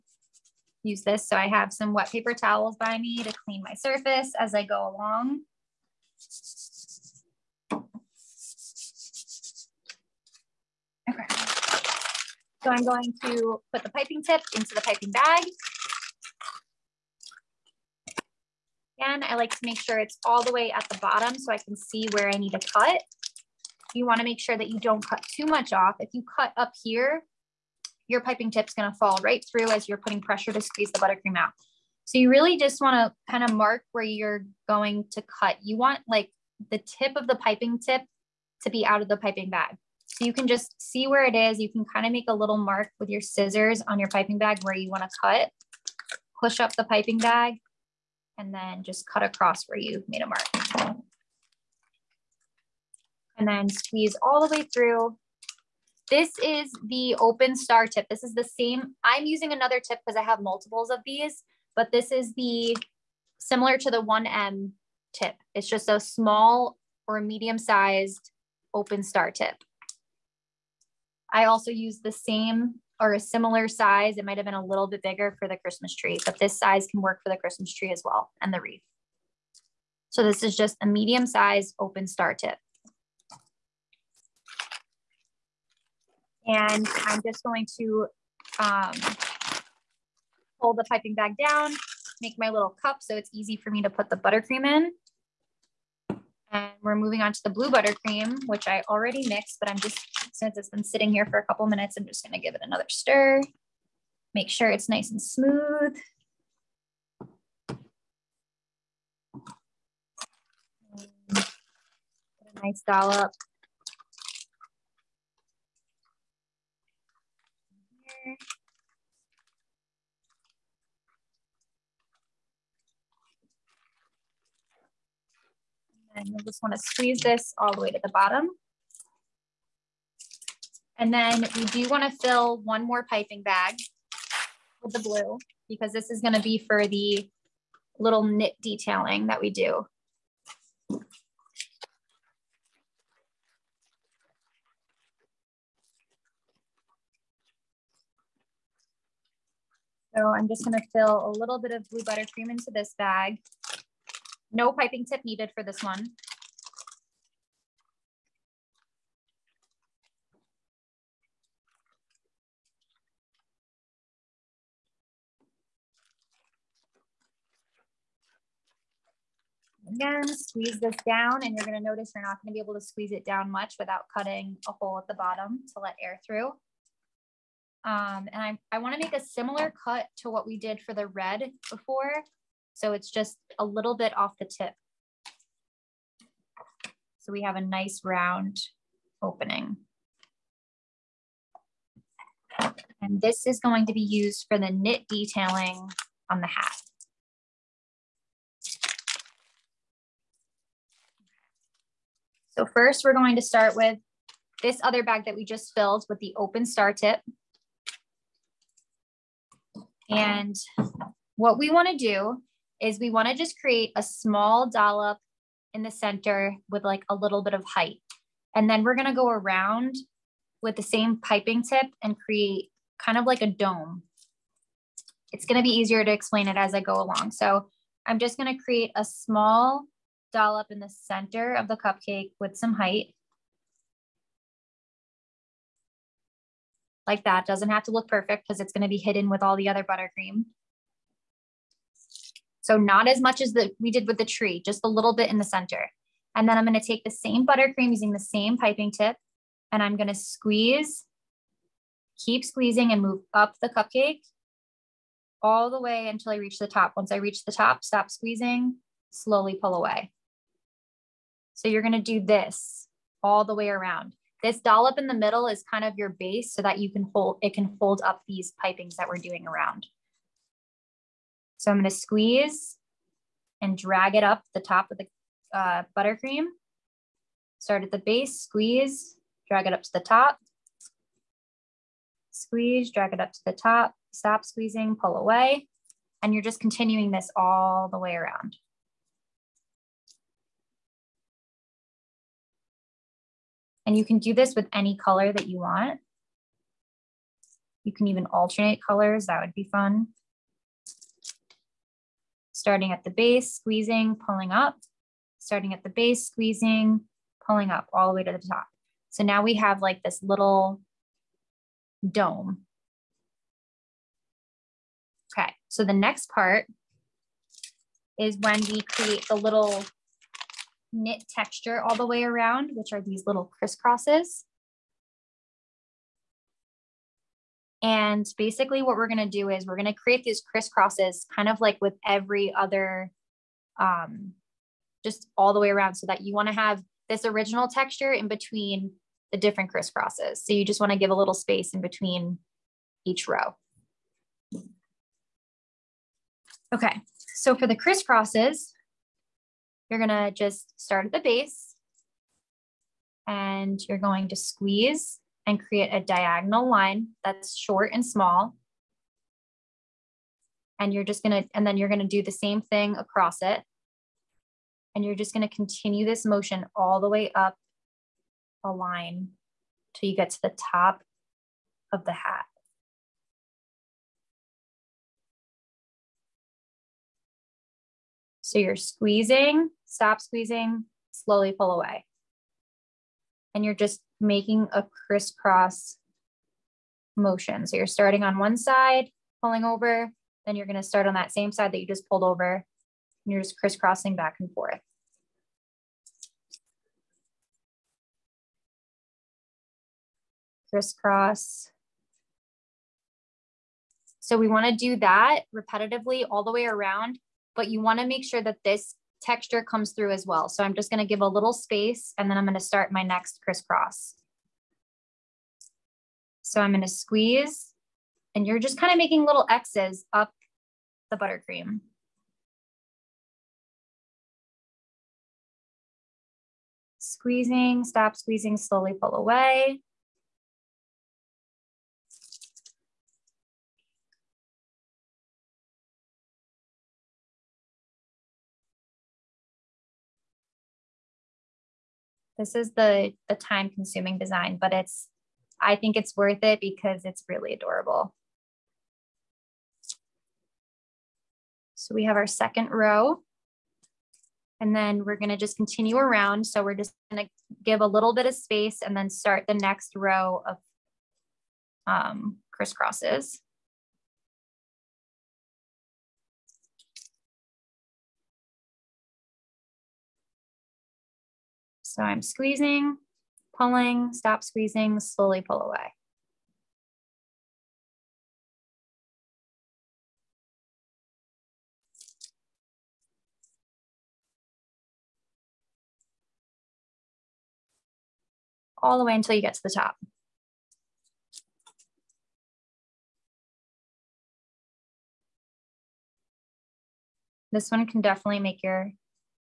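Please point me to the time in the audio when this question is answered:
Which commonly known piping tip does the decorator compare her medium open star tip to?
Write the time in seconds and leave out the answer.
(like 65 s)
64 s.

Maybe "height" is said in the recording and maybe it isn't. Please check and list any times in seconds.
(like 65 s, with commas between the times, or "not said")
217 s, 232 s.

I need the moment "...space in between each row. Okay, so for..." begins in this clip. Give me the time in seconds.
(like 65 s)
341 s.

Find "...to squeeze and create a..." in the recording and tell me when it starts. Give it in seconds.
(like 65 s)
354 s.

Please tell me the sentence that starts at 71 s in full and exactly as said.
I also use the same or a similar size.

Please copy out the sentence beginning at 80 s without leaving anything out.
So this is just a medium sized open star tip.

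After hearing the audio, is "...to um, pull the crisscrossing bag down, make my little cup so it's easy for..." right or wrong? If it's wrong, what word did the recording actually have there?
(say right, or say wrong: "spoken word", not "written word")
wrong: "piping", not "crisscrossing".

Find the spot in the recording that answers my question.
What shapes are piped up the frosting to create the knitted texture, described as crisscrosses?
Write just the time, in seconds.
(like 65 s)
419 s.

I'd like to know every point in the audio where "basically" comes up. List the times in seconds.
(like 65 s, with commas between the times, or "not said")
328 s.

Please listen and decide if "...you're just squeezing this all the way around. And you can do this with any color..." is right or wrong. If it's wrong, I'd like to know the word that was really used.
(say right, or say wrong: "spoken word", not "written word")
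wrong: "continuing", not "squeezing".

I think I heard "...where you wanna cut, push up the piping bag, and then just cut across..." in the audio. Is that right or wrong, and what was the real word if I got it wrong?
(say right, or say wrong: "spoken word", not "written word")
right.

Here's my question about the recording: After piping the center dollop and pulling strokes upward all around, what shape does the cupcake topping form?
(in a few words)
a dome.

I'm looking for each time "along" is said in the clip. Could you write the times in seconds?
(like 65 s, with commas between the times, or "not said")
4 s, 226 s.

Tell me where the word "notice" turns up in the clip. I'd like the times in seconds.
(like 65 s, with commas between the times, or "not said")
171 s.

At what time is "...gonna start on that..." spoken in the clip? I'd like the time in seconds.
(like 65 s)
390 s.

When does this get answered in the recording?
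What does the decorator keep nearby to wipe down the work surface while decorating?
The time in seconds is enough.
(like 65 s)
1 s.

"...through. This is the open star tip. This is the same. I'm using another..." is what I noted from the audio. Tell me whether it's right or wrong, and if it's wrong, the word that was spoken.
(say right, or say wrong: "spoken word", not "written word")
right.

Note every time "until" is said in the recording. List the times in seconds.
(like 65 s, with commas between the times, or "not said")
256 s, 489 s.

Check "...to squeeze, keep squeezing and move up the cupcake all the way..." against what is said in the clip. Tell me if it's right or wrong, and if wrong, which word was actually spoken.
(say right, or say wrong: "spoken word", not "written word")
right.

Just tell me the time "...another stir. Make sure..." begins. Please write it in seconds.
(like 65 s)
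102 s.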